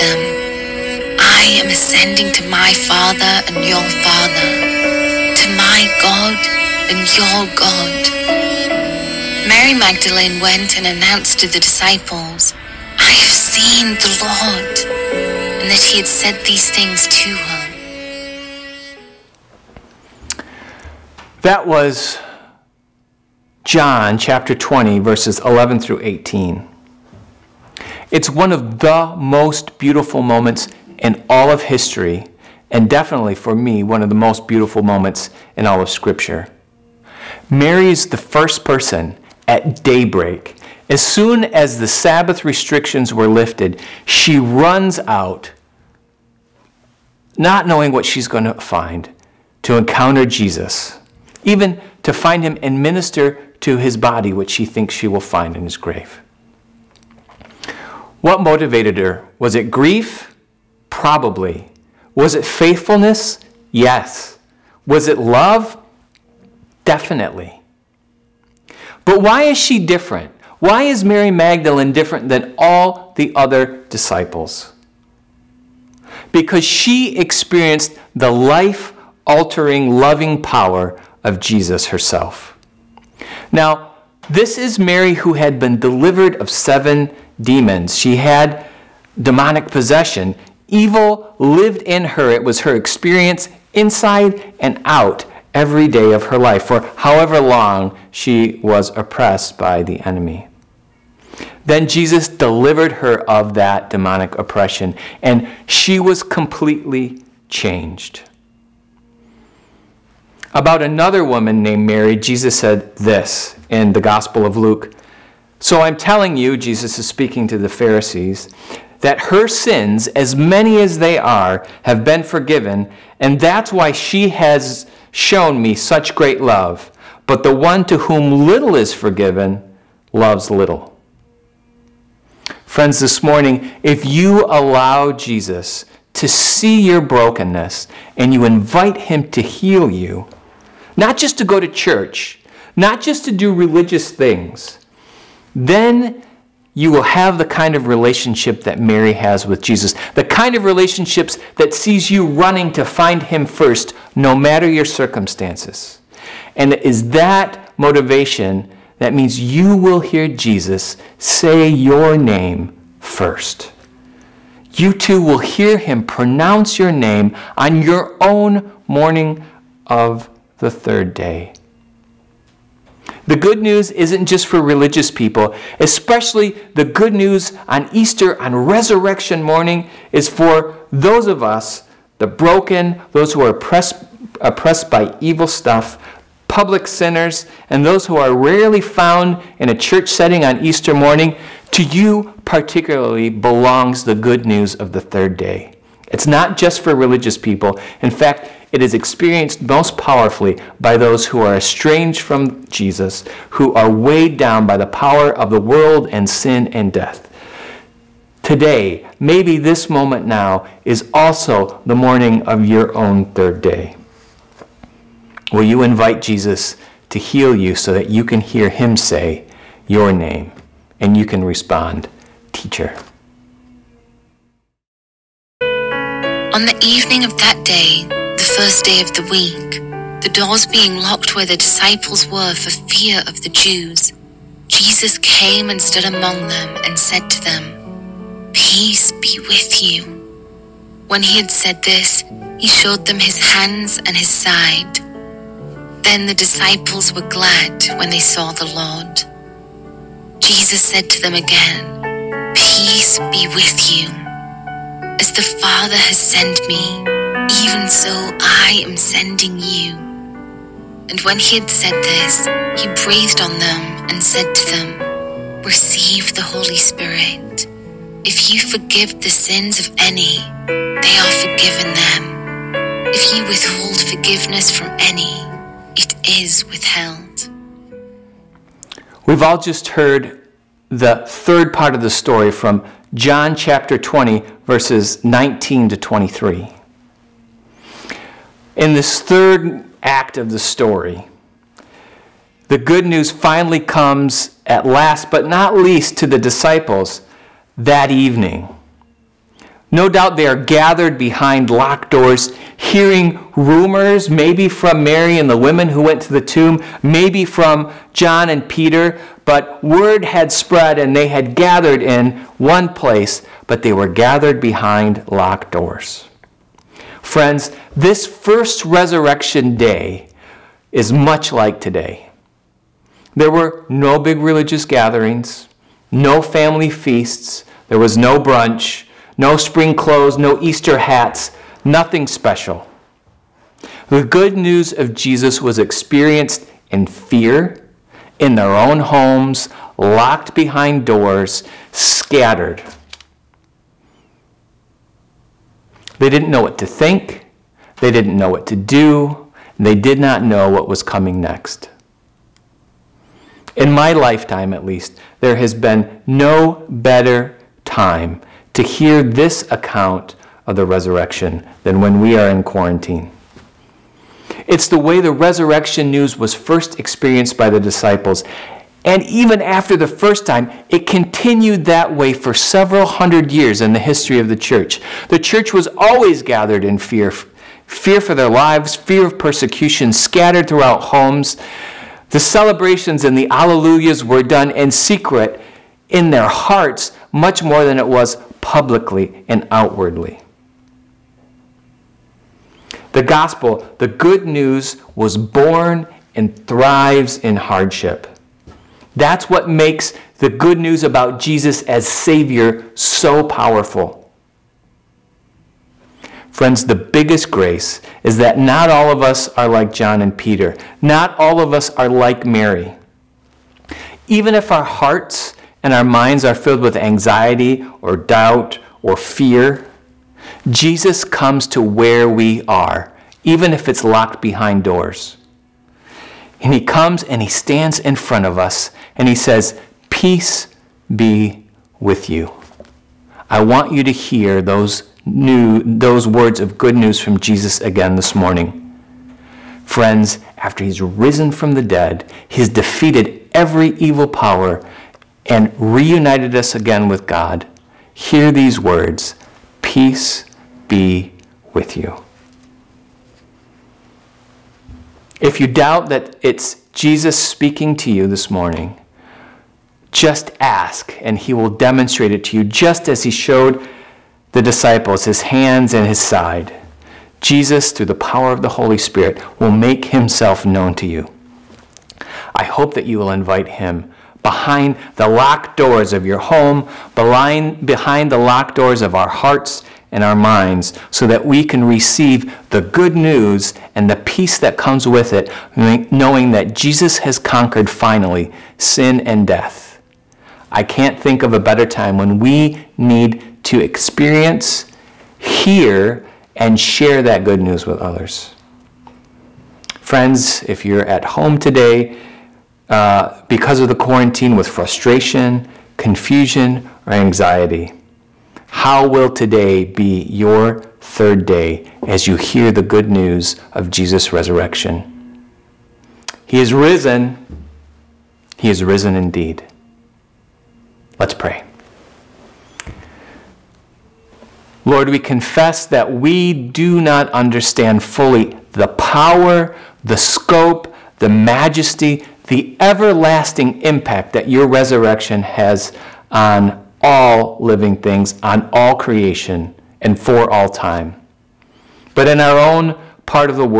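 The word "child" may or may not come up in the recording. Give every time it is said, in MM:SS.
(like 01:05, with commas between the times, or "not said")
not said.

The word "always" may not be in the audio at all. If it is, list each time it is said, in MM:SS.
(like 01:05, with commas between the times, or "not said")
06:15.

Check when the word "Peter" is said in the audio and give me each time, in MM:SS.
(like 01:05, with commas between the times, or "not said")
05:08, 06:50.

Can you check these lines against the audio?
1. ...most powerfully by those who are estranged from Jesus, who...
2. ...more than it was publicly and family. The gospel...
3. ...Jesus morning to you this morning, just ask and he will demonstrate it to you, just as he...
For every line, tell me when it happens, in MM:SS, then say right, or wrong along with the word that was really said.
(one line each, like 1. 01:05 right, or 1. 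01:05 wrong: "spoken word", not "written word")
1. 03:19 right
2. 06:27 wrong: "outwardly", not "family"
3. 07:36 wrong: "speaking", not "morning".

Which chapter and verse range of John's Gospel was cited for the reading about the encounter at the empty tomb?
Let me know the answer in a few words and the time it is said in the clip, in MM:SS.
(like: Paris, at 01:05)
John 20:11-18, at 00:23.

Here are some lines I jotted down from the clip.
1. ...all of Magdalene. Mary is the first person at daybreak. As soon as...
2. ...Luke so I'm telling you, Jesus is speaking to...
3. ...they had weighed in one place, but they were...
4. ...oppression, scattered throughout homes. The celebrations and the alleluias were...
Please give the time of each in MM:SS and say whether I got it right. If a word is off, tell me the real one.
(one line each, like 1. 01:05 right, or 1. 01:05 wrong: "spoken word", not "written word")
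1. 00:35 wrong: "Scripture", not "Magdalene"
2. 01:54 right
3. 05:11 wrong: "gathered", not "weighed"
4. 06:19 wrong: "persecution", not "oppression".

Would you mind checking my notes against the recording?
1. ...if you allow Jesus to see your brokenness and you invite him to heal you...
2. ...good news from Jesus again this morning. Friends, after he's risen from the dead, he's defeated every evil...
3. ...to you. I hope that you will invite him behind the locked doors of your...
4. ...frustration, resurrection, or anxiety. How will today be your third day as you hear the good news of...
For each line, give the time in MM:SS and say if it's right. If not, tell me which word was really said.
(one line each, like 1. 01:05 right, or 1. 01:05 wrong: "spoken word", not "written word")
1. 02:13 right
2. 07:16 right
3. 07:50 right
4. 08:24 wrong: "confusion", not "resurrection".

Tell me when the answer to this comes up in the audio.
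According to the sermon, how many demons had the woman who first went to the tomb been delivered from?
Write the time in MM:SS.
01:26.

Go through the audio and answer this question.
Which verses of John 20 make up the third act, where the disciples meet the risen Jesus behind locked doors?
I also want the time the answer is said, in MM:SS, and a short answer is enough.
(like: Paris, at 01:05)
19 to 23, at 04:44.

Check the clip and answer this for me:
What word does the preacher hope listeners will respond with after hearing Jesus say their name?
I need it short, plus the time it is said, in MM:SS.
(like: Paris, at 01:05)
Teacher, at 03:42.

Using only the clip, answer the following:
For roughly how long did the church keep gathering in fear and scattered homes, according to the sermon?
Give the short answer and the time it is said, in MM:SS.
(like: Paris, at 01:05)
Several hundred years, at 06:12.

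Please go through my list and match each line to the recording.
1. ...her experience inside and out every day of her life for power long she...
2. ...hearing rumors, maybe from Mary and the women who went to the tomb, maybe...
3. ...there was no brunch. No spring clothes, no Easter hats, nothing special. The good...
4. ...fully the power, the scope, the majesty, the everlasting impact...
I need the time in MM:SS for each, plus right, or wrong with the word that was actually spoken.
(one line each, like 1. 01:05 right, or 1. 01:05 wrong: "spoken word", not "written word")
1. 01:32 wrong: "however", not "power"
2. 05:02 right
3. 05:27 right
4. 08:48 right.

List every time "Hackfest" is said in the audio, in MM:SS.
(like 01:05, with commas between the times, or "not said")
not said.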